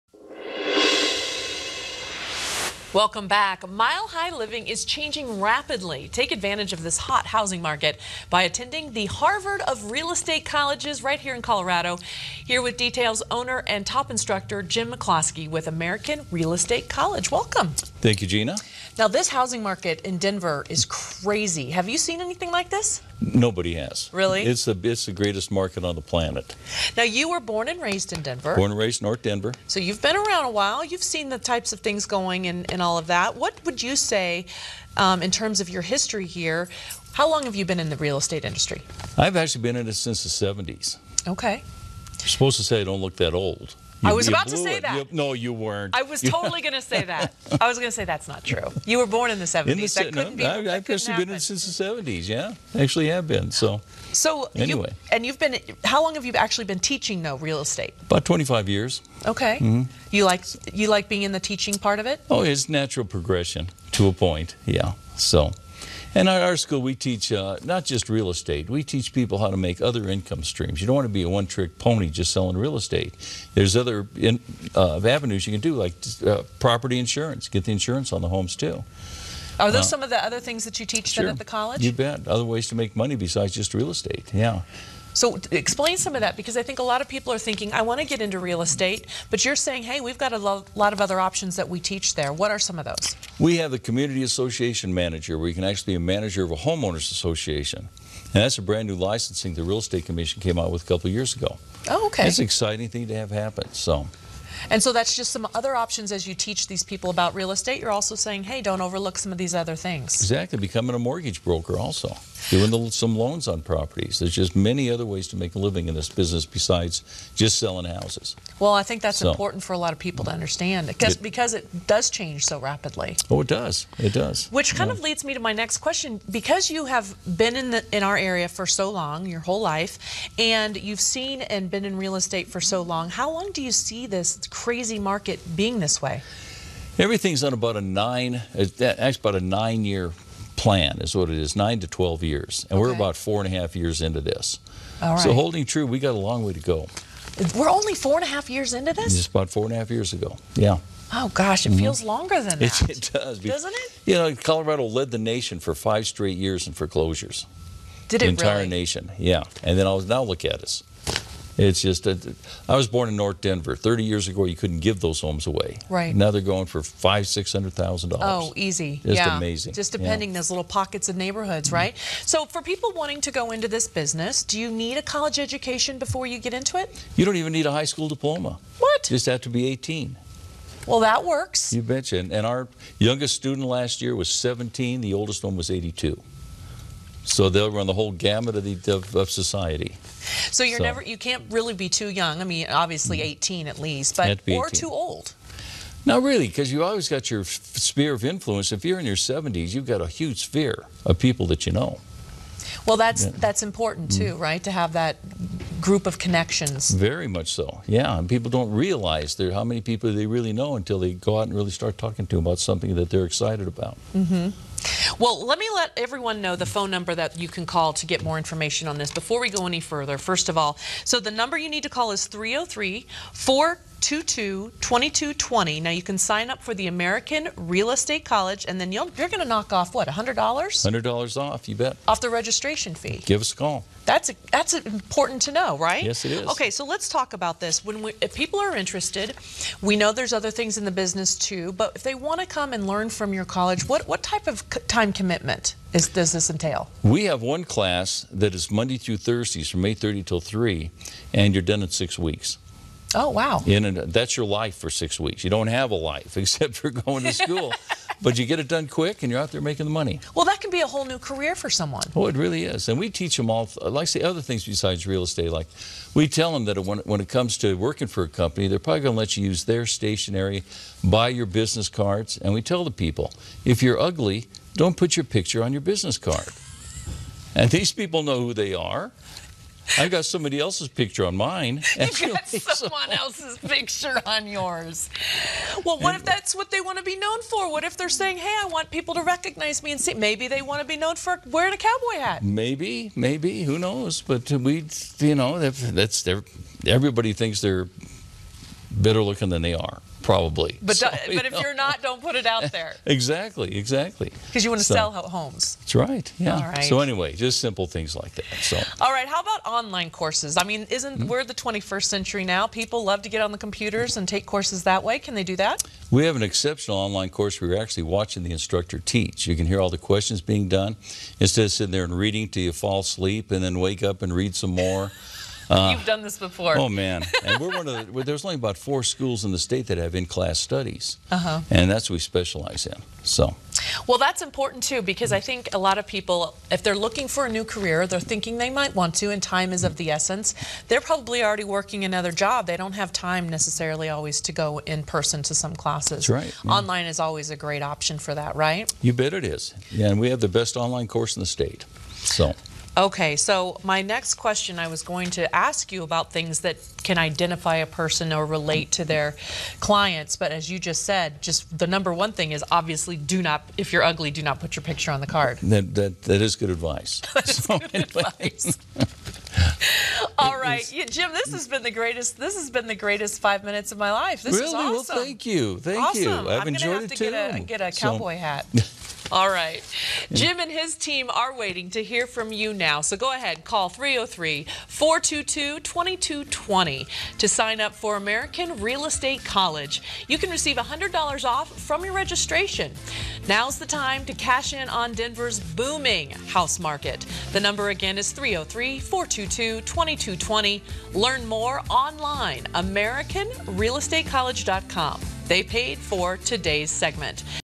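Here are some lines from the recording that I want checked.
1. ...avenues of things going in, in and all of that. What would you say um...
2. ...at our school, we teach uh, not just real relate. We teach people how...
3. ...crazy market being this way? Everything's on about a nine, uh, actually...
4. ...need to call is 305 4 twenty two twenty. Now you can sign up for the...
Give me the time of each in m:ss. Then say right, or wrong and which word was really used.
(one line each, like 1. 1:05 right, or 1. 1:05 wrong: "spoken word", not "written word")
1. 0:31 wrong: "types", not "avenues"
2. 1:06 wrong: "estate", not "relate"
3. 2:14 right
4. 3:41 wrong: "303", not "305".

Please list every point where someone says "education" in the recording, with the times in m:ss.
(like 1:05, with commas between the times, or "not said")
2:55.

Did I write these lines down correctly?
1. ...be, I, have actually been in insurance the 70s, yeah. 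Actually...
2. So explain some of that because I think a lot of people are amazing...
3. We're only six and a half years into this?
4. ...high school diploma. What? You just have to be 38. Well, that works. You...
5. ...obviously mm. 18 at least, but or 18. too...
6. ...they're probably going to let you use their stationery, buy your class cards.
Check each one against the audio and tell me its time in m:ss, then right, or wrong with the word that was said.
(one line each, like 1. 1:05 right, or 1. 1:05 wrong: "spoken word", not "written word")
1. 0:50 wrong: "since", not "insurance"
2. 1:25 wrong: "thinking", not "amazing"
3. 2:27 wrong: "four", not "six"
4. 2:57 wrong: "18", not "38"
5. 3:12 right
6. 4:28 wrong: "business", not "class".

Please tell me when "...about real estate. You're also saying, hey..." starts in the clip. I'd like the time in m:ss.
1:47.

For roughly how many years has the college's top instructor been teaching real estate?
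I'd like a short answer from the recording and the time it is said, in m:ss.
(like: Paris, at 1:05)
25 years, at 0:58.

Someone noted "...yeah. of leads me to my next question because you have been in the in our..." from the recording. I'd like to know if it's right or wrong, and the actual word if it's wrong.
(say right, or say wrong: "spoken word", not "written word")
right.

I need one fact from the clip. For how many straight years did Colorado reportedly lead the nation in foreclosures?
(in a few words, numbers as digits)
5.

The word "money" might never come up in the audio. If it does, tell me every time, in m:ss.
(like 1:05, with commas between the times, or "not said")
1:22, 4:19.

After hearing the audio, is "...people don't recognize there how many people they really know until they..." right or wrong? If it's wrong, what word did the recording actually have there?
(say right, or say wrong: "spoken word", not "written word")
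wrong: "realize", not "recognize".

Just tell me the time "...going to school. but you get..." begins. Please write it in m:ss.
4:16.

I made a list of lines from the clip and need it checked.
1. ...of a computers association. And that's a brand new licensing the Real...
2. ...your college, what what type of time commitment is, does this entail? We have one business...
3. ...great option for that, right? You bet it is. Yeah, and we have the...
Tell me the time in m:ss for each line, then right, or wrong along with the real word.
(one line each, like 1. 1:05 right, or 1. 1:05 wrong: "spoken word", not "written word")
1. 1:36 wrong: "homeowners", not "computers"
2. 4:03 wrong: "class", not "business"
3. 5:47 right.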